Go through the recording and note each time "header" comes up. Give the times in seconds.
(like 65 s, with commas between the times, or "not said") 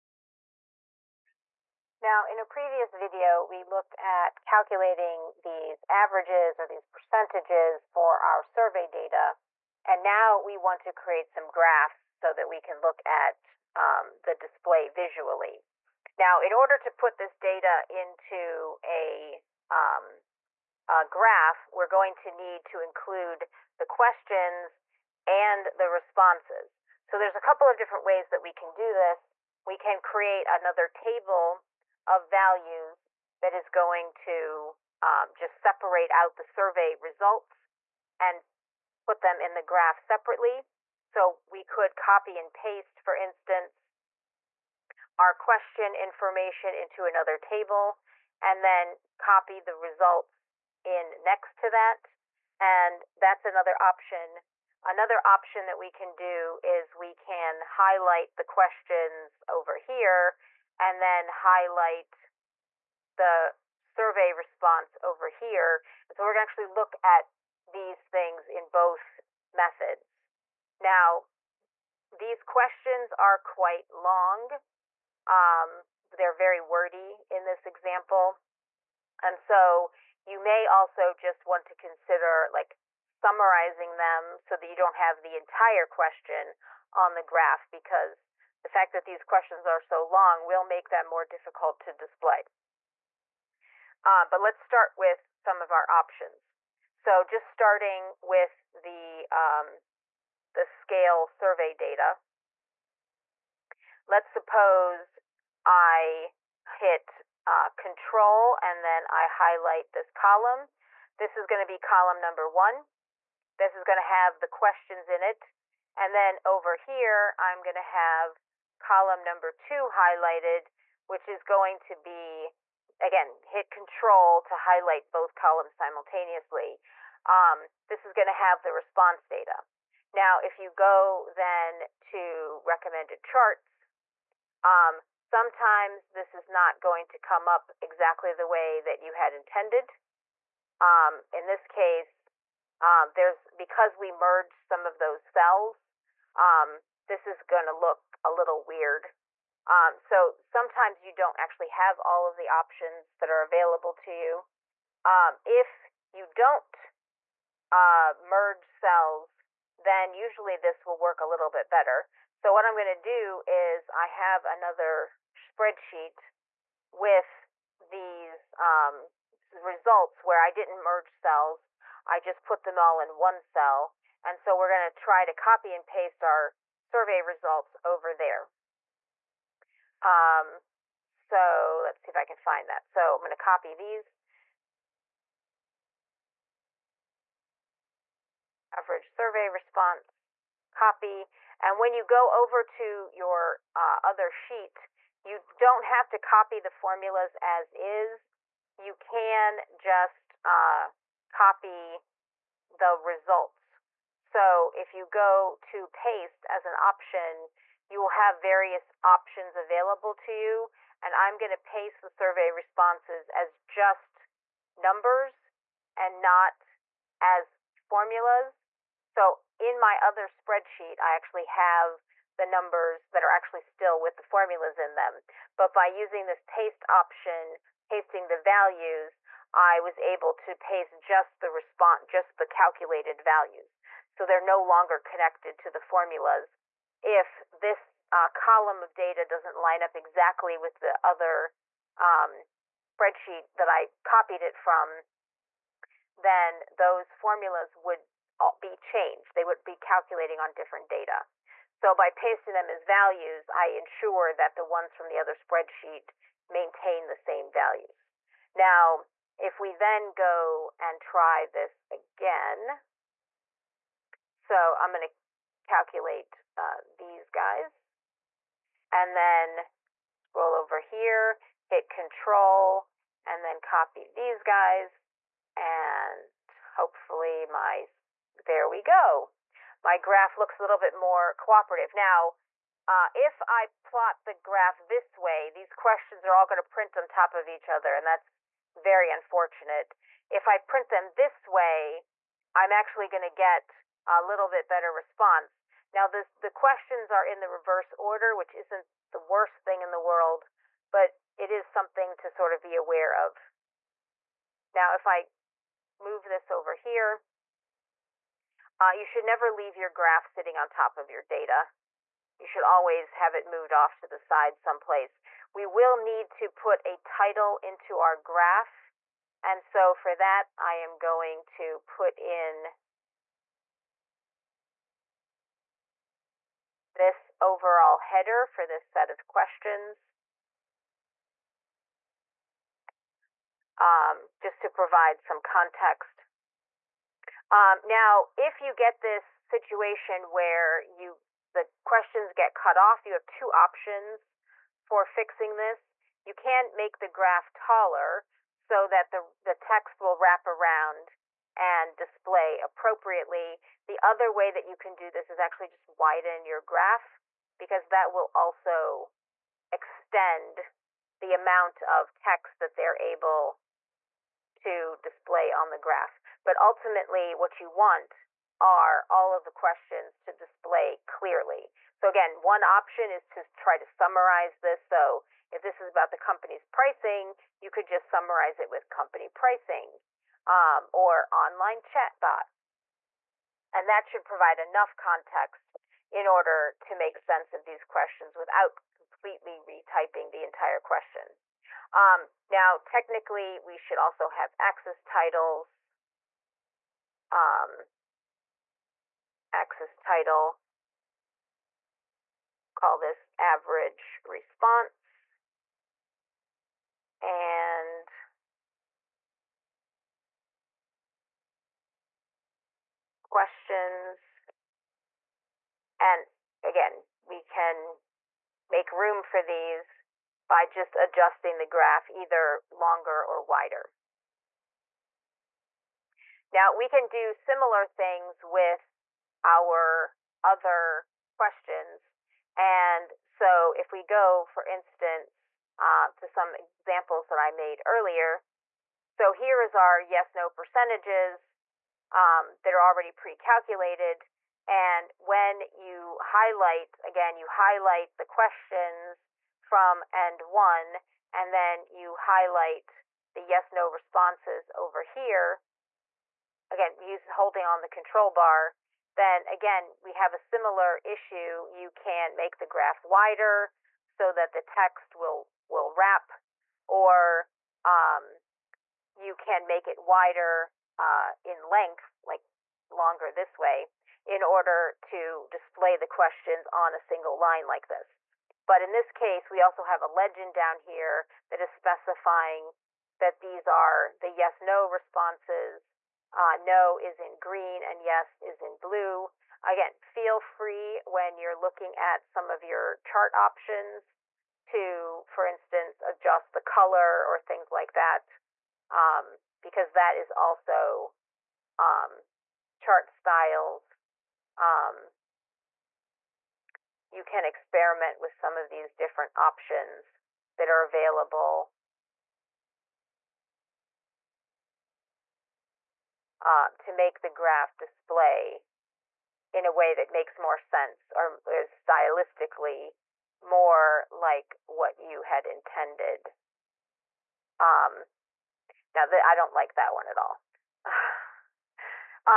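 327 s.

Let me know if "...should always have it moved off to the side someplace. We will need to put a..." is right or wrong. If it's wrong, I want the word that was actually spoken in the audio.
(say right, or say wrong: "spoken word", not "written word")
right.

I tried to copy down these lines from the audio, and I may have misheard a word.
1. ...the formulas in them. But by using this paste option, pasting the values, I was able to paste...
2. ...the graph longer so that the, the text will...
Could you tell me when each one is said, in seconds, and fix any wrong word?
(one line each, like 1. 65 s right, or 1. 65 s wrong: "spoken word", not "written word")
1. 224 s right
2. 346 s wrong: "taller", not "longer".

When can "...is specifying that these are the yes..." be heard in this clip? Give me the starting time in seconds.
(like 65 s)
481 s.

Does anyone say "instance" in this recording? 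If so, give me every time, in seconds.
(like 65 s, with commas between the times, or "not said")
43 s, 434 s, 495 s.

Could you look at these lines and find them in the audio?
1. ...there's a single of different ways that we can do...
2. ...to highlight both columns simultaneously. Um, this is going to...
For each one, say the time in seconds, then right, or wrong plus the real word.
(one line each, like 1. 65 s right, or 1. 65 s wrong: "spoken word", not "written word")
1. 27 s wrong: "couple", not "single"
2. 124 s right.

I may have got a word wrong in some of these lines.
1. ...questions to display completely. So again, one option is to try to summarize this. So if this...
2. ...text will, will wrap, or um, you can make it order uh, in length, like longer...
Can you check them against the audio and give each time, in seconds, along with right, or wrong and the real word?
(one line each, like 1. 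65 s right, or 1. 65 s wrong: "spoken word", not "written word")
1. 369 s wrong: "clearly", not "completely"
2. 464 s wrong: "wider", not "order".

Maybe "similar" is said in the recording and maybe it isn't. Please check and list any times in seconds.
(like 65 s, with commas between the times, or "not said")
427 s, 460 s.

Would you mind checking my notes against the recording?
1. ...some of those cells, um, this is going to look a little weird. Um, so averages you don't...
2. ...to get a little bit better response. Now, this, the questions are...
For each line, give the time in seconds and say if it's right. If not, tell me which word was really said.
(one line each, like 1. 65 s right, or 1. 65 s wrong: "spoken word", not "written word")
1. 144 s wrong: "sometimes", not "averages"
2. 293 s right.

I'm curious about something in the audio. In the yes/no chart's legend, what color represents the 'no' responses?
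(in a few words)
Green.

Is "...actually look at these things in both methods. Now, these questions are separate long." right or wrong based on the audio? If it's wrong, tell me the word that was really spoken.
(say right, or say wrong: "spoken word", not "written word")
wrong: "quite", not "separate".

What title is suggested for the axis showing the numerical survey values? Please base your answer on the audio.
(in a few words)
Average response.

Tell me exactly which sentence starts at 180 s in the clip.
Um, so let's see if I can find that.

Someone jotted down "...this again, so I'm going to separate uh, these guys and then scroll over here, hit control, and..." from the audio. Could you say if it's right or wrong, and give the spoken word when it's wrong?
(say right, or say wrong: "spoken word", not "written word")
wrong: "calculate", not "separate".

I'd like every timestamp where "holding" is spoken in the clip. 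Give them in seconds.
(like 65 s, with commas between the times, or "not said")
457 s.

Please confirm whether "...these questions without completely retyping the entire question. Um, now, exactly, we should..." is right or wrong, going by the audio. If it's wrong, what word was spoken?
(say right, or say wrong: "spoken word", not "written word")
wrong: "technically", not "exactly".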